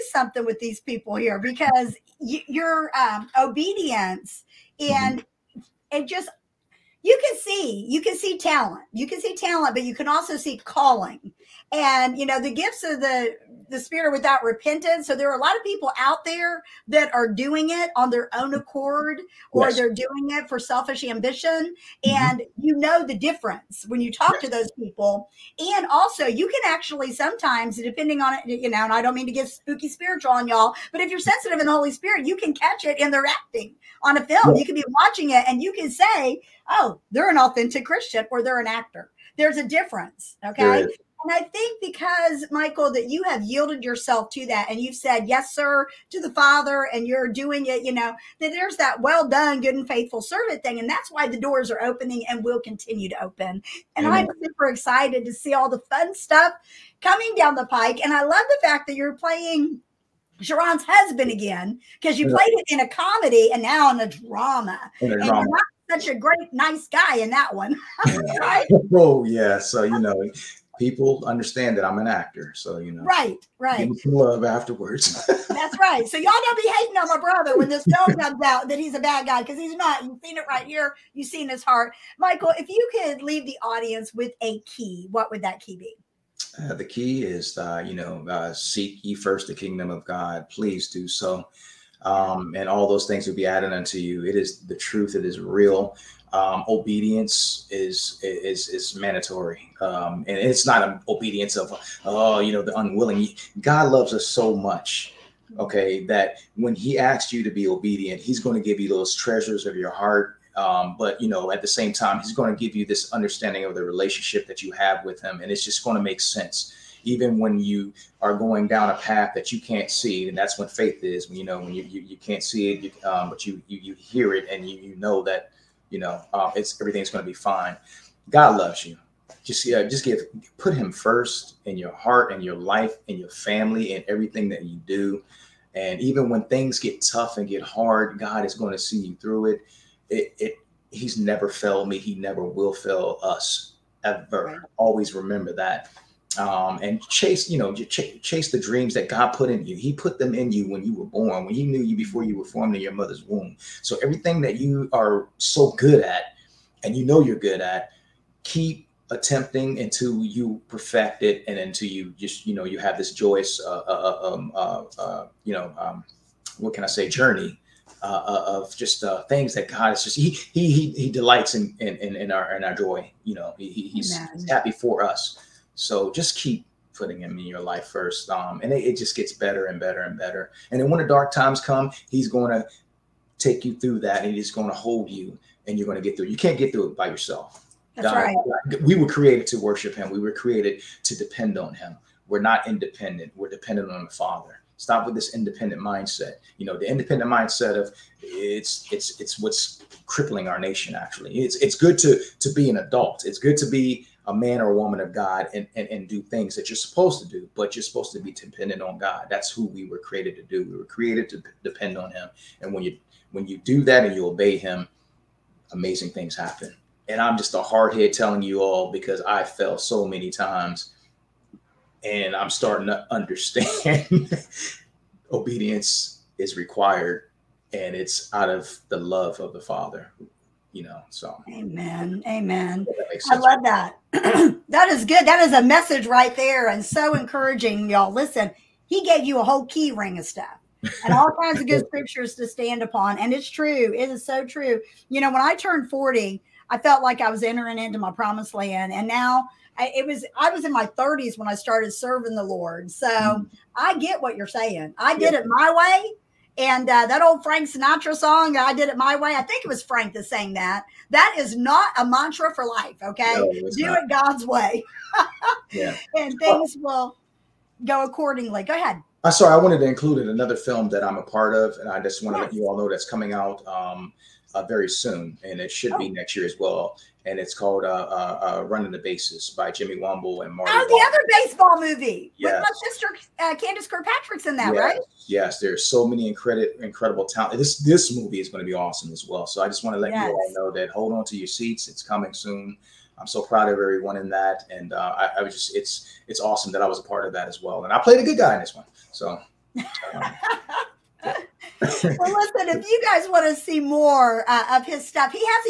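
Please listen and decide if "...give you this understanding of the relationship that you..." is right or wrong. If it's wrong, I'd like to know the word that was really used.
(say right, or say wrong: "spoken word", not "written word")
right.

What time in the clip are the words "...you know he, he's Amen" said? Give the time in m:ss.
2:53.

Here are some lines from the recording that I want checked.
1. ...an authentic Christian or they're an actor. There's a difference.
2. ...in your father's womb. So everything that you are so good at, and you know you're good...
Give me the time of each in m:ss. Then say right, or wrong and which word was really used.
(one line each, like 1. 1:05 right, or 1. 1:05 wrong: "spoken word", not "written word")
1. 0:37 right
2. 2:32 wrong: "mother", not "father".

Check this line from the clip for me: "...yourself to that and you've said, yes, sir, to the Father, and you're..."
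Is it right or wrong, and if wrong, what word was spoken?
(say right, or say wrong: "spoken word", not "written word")
right.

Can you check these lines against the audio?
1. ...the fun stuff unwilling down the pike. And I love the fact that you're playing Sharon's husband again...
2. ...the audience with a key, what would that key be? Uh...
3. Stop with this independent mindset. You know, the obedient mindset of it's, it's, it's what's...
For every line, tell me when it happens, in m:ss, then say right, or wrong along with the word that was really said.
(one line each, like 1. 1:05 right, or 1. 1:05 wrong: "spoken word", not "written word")
1. 0:55 wrong: "coming", not "unwilling"
2. 1:23 right
3. 3:14 wrong: "independent", not "obedient".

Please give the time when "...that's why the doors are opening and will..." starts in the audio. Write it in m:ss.
0:50.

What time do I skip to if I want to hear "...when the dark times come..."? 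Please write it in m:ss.
3:00.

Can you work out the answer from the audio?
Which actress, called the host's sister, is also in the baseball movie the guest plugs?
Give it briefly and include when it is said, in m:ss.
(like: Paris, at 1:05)
Candace Kirkpatrick, at 4:43.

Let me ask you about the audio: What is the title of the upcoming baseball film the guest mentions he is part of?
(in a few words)
Running the Bases.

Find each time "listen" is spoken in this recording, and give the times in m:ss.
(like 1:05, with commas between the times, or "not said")
3:58, 5:01.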